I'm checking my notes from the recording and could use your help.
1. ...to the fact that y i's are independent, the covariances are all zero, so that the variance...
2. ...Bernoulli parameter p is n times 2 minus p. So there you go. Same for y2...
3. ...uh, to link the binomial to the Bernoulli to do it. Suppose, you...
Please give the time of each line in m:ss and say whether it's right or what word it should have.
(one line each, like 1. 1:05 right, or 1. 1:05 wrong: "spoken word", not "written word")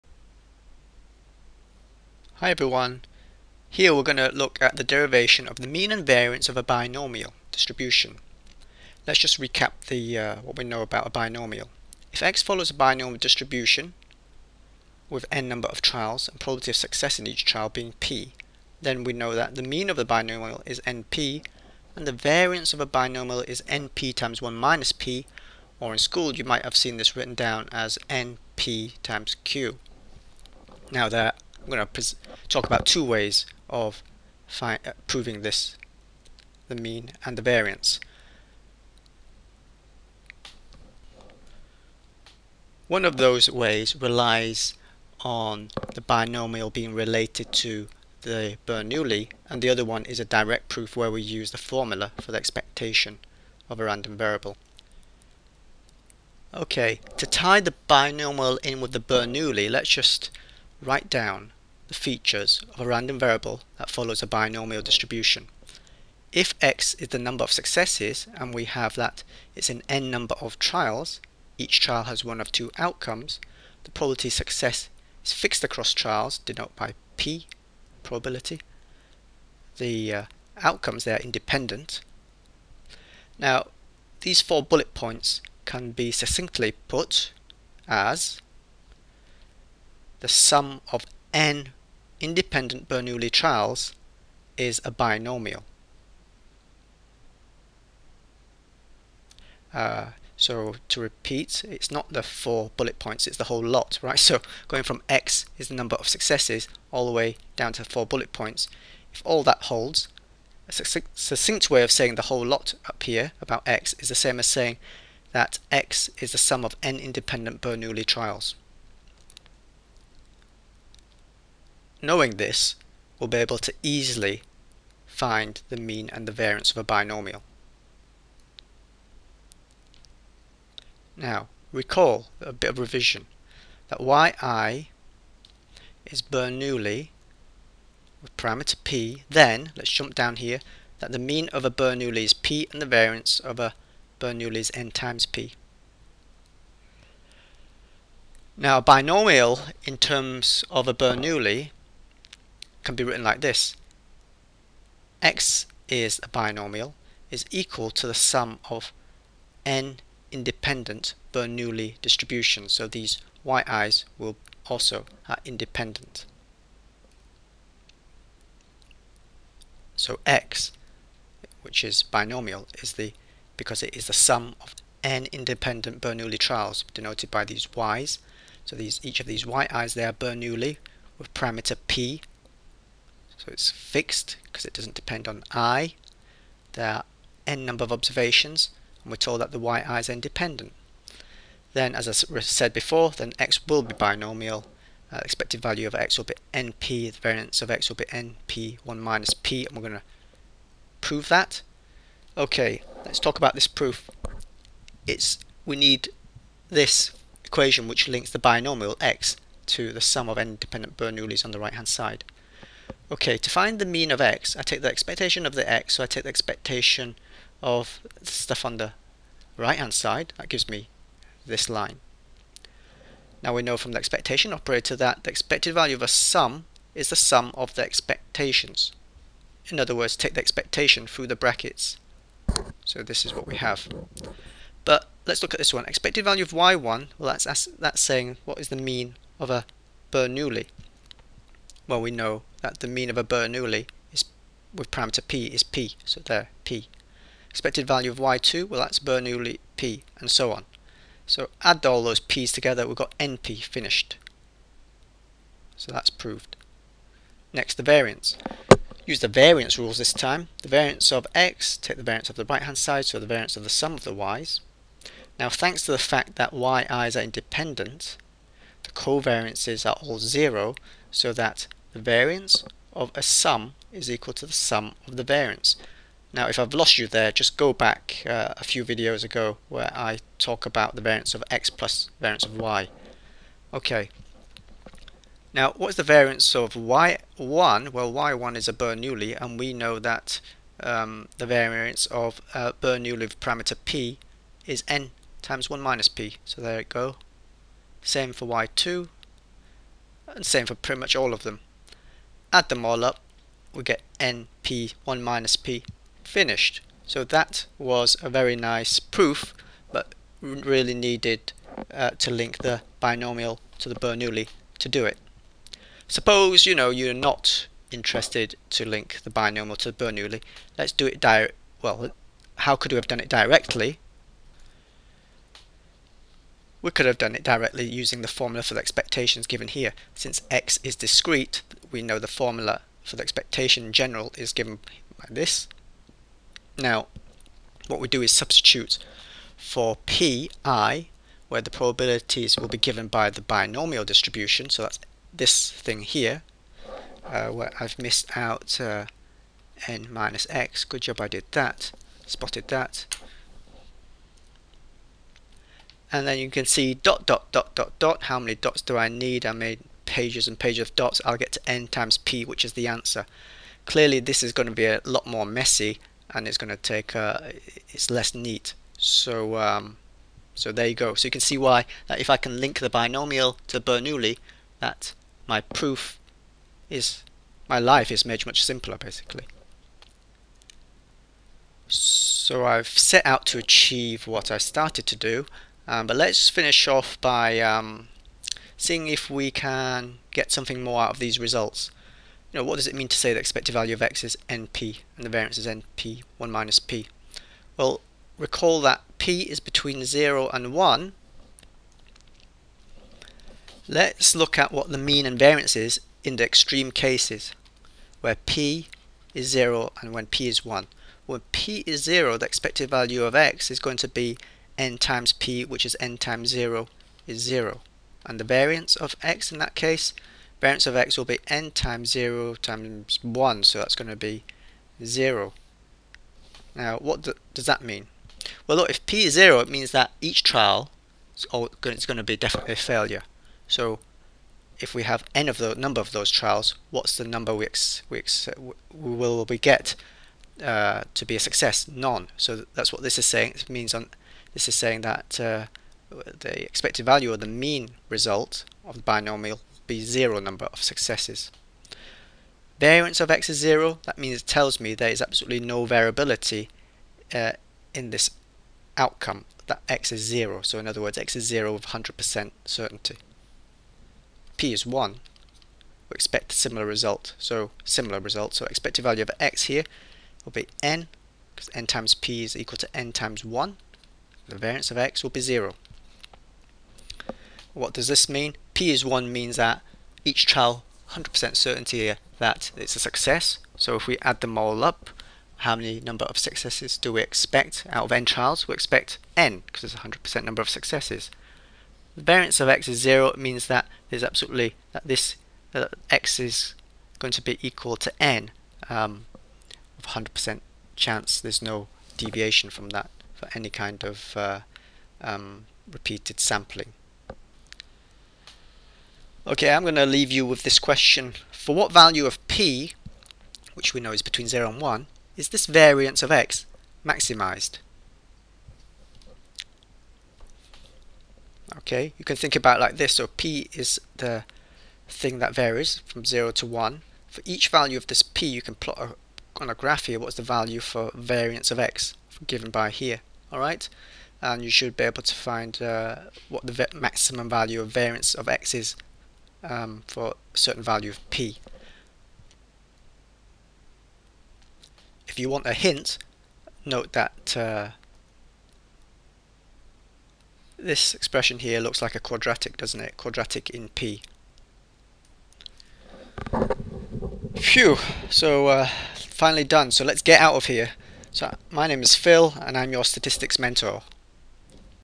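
1. 4:25 right
2. 4:52 wrong: "1", not "2"
3. 5:11 right.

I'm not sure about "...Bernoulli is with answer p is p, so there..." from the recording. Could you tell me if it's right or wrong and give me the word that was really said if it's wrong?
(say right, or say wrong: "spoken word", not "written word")
wrong: "parameter", not "answer".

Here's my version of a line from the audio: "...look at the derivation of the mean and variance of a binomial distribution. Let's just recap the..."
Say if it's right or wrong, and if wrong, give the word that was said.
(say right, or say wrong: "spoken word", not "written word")
right.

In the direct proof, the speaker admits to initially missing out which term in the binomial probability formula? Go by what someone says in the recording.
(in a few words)
n minus x.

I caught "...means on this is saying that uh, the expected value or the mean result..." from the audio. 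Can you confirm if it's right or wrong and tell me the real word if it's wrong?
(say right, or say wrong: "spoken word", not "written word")
right.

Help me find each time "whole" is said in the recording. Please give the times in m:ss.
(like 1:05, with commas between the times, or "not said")
1:43, 1:52.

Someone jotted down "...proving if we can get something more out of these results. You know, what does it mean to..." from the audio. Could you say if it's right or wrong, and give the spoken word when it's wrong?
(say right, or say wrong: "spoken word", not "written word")
wrong: "seeing", not "proving".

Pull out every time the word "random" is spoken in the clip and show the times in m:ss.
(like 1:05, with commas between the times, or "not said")
0:53, 1:02.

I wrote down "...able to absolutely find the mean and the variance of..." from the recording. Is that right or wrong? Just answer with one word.
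wrong.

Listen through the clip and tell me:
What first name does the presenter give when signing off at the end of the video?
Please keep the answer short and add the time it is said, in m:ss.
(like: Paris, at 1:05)
Phil, at 9:22.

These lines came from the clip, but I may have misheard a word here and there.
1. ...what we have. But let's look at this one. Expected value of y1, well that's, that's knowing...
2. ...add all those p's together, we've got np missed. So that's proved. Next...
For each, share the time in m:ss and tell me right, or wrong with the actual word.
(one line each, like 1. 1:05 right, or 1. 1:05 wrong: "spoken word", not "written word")
1. 3:53 wrong: "saying", not "knowing"
2. 4:11 wrong: "finished", not "missed".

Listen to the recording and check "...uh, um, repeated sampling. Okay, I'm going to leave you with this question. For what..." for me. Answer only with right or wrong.
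right.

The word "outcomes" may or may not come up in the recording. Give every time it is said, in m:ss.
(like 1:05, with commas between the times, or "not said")
1:12, 1:20, 7:38.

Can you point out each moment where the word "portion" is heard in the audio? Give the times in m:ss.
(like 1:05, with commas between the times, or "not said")
not said.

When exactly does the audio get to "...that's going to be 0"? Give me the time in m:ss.
7:03.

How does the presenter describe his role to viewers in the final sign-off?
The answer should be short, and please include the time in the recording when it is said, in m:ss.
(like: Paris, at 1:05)
Statistics mentor, at 9:23.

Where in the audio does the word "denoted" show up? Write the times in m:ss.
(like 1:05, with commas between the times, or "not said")
1:16, 2:56.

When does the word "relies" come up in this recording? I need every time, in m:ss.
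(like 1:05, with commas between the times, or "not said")
0:43.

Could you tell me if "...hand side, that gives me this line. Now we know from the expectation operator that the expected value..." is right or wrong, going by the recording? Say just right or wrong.
right.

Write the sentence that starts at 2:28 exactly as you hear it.
Now, a binomial in terms of a Bernoulli can be written like this.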